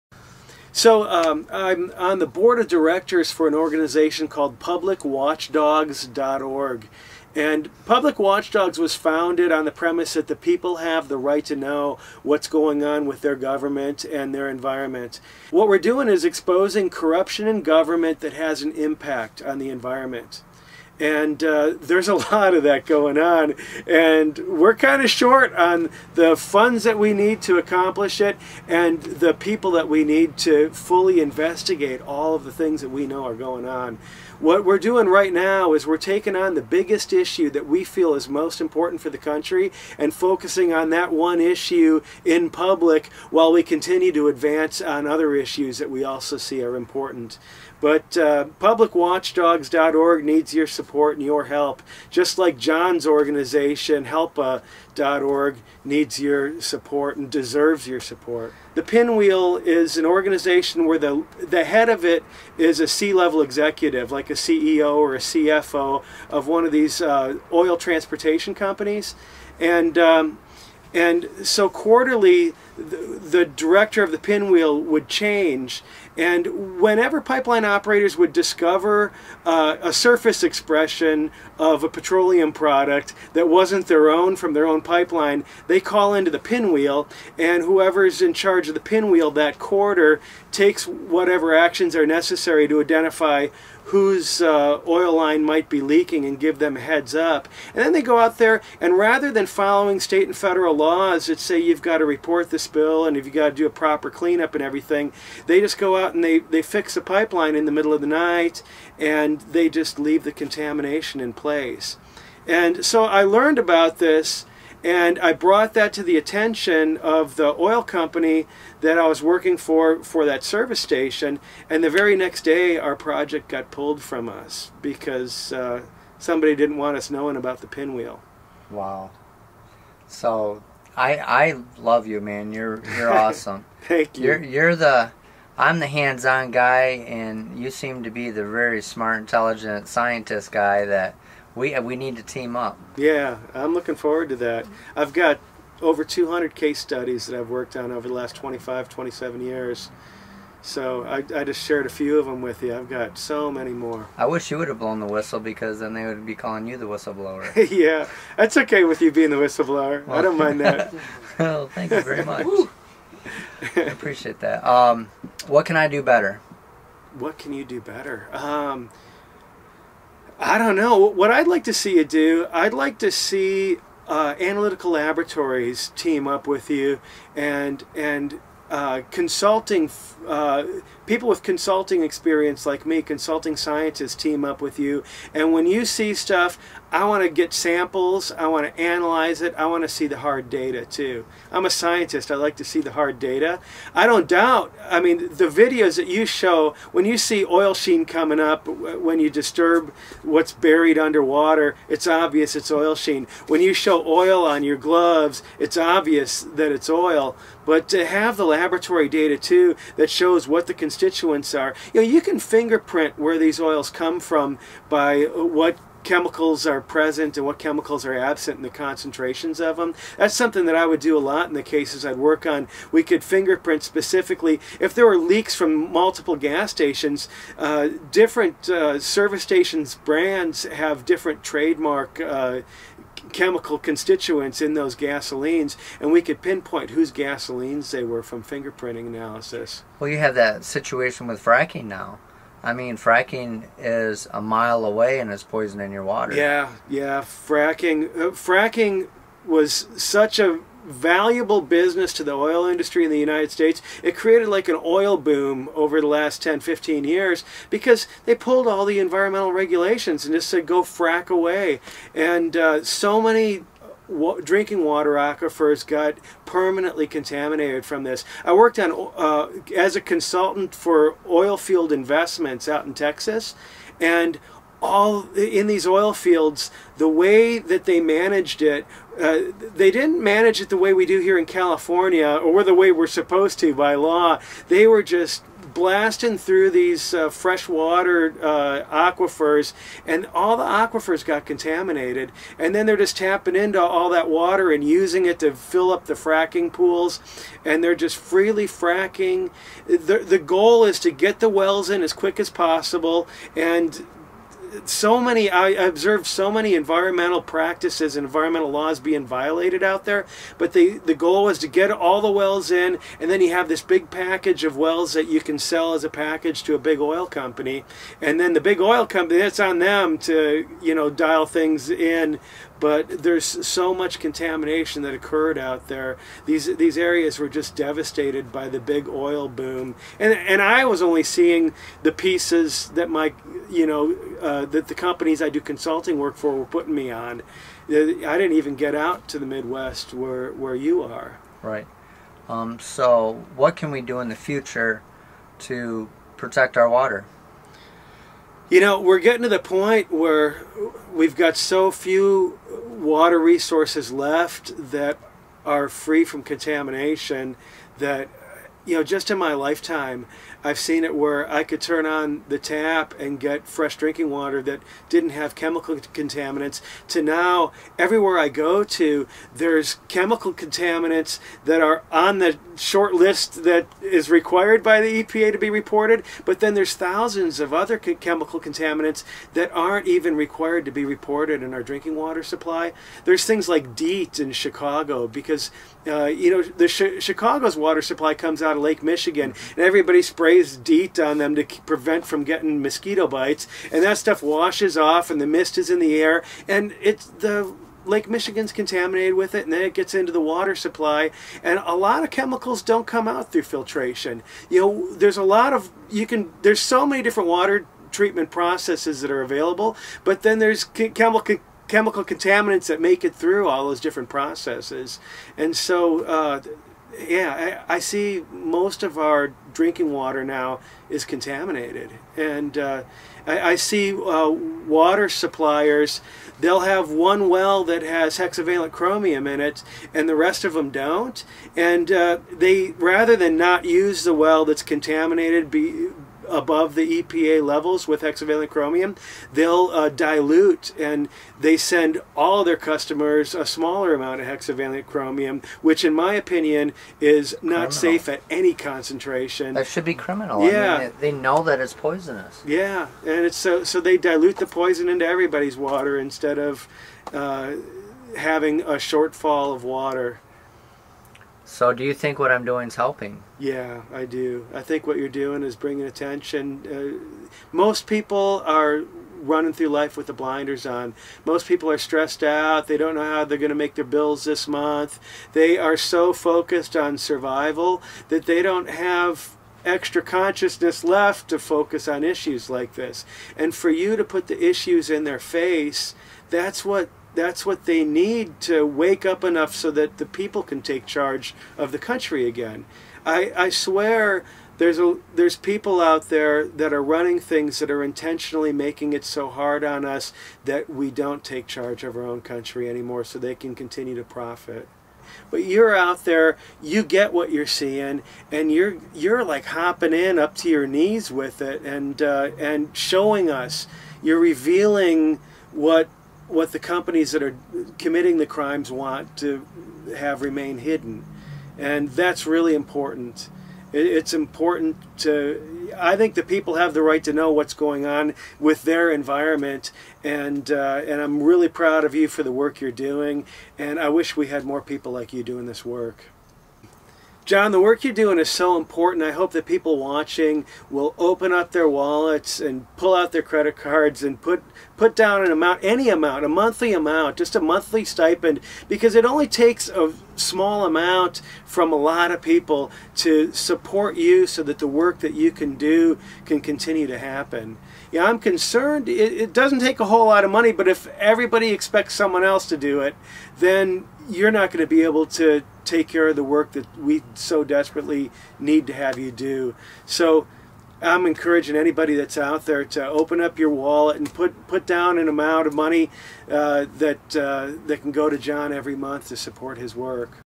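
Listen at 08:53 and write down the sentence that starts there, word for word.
And I wish we had more people like you doing this work.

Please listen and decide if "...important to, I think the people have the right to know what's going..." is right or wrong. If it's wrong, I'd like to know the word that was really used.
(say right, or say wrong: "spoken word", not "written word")
right.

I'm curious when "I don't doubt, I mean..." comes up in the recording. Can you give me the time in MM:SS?
03:13.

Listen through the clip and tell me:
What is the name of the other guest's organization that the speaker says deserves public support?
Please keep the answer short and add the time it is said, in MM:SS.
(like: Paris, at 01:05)
HELPPA.org, at 00:54.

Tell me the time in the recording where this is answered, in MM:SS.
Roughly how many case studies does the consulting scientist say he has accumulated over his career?
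02:25.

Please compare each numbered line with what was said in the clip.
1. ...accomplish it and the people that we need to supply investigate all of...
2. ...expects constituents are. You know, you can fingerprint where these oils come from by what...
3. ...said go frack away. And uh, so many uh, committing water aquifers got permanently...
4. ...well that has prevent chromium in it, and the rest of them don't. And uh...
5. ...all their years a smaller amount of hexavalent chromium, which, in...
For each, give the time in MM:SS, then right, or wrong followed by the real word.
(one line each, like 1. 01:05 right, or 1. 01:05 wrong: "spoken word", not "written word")
1. 00:27 wrong: "fully", not "supply"
2. 03:30 wrong: "constituents", not "expects"
3. 04:20 wrong: "drinking", not "committing"
4. 07:07 wrong: "hexavalent", not "prevent"
5. 07:22 wrong: "customers", not "years".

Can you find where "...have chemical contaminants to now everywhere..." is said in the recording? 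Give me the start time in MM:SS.
06:05.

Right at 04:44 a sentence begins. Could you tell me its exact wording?
They were just blasting through these uh, freshwater uh, aquifers, and all the aquifers got contaminated.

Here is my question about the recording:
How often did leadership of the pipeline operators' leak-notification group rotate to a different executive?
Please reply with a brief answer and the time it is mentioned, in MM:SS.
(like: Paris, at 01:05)
Quarterly, at 01:11.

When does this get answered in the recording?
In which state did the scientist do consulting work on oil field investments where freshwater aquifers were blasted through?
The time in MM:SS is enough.
04:32.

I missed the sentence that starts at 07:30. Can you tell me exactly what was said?
Yeah, I mean, they, know that it's poisonous.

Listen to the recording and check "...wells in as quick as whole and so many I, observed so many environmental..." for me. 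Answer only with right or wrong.
wrong.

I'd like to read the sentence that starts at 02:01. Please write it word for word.
And the very next day, our project got pulled from us because uh, somebody didn't want us knowing about the pinwheel.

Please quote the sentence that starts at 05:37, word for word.
I didn't even get out to the Midwest where where you are.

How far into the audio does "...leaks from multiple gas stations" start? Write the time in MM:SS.
03:45.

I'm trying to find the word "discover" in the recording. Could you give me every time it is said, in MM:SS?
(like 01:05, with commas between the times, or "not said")
01:18.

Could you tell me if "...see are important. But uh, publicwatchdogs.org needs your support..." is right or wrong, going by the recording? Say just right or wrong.
right.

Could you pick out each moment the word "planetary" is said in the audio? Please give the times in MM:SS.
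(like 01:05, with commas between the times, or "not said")
not said.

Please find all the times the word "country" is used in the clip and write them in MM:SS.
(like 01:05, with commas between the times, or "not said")
00:39, 08:11, 08:22.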